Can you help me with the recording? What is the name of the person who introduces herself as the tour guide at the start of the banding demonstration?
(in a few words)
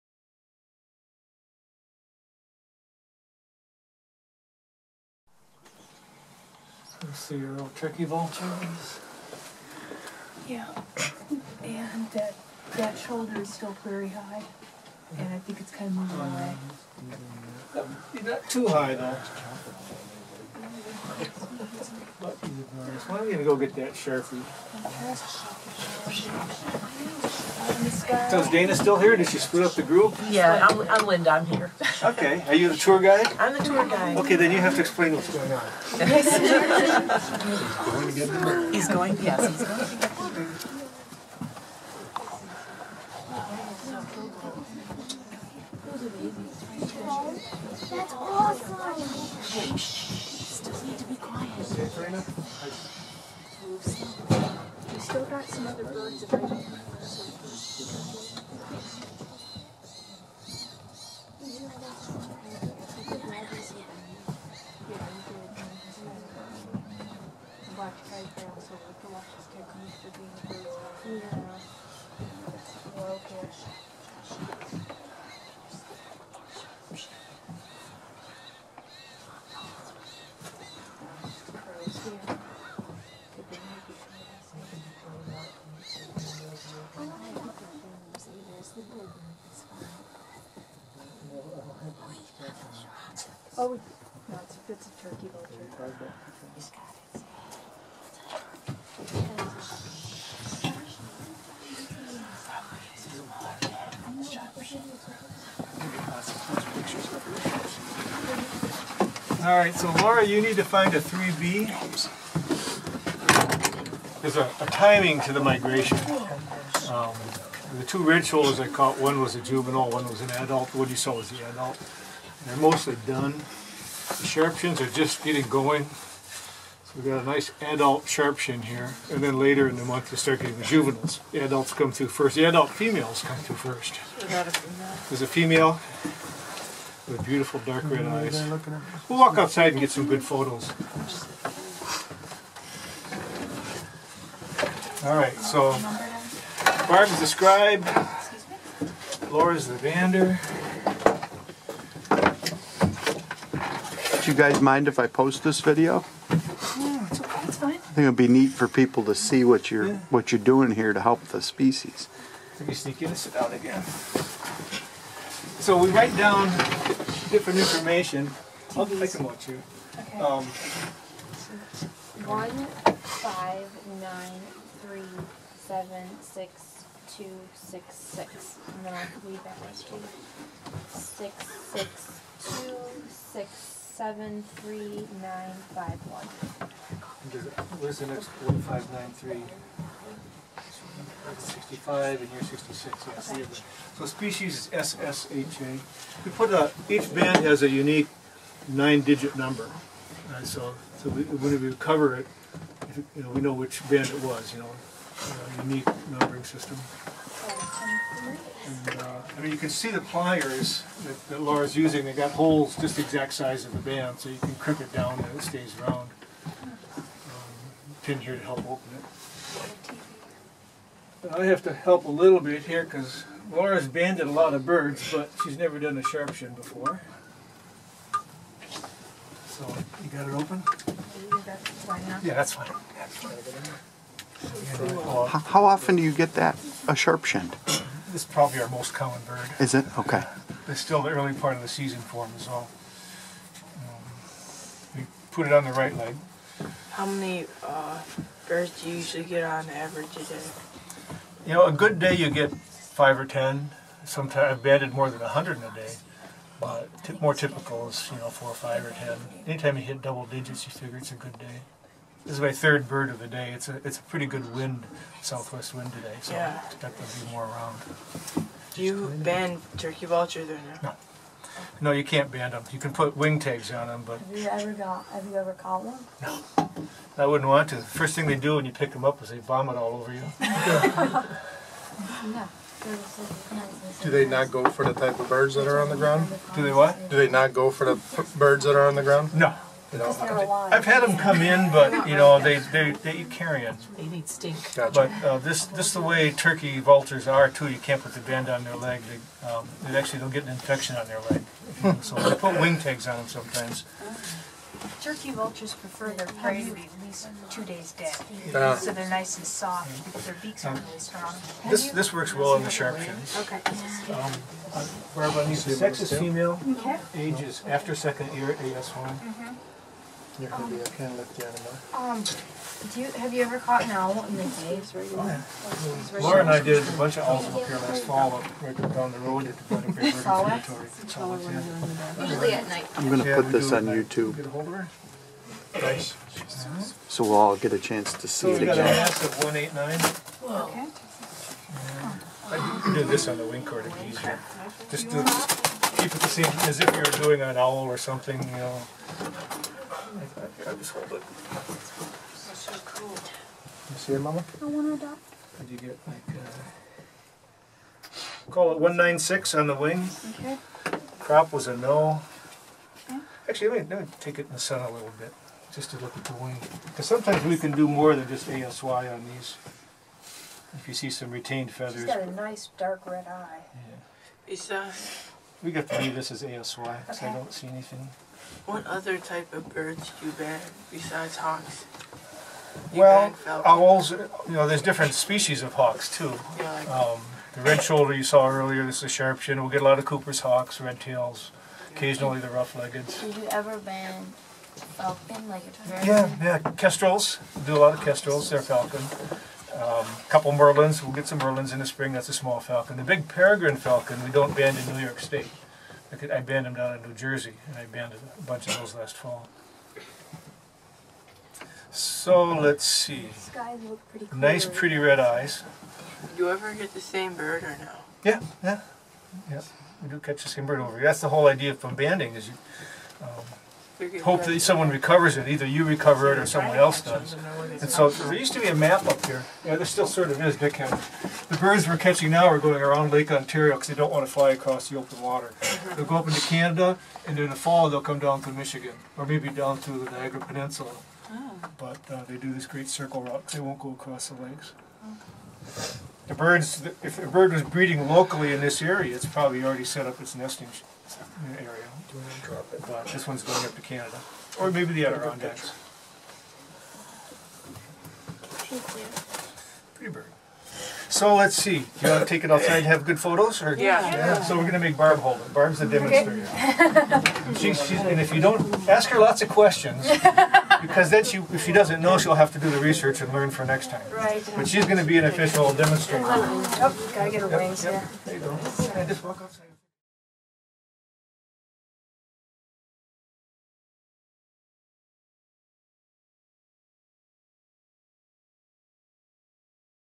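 Linda.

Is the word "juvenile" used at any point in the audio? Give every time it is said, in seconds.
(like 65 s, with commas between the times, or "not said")
119 s, 130 s.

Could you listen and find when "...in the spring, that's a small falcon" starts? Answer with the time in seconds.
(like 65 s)
401 s.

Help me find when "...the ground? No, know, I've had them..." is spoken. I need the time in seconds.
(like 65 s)
288 s.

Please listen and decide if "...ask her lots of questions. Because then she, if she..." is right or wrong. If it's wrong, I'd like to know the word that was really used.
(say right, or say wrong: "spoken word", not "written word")
right.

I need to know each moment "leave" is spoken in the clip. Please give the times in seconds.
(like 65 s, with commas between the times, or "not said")
179 s, 376 s.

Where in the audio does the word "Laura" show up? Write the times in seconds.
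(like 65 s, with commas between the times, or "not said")
110 s, 149 s, 211 s, 223 s, 326 s.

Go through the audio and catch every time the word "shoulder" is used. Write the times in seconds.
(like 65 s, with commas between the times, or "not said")
12 s, 118 s, 387 s.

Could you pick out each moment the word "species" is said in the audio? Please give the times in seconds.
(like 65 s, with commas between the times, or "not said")
161 s, 194 s, 385 s.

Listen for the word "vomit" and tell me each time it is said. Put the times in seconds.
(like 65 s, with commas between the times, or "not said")
279 s.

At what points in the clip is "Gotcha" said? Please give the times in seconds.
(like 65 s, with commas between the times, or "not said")
294 s.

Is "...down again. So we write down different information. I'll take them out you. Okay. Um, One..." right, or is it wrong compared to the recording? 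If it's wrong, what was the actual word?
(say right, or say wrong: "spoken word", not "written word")
right.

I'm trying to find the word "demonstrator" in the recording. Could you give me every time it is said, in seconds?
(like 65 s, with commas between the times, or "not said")
465 s, 475 s.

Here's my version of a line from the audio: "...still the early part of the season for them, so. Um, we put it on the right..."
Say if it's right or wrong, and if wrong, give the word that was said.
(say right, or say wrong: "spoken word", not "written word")
right.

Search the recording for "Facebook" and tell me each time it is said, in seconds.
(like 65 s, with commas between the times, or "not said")
not said.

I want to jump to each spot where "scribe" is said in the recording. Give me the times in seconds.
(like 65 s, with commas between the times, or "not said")
147 s.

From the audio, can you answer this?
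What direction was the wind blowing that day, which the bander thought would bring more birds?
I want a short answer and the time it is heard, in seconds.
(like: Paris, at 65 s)
Southwest, at 265 s.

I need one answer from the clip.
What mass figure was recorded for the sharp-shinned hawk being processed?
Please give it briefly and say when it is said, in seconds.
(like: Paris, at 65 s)
189, at 339 s.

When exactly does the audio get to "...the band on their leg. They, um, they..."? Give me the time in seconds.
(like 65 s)
298 s.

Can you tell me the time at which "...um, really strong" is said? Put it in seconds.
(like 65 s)
310 s.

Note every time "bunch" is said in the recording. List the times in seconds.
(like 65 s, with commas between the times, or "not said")
326 s, 408 s.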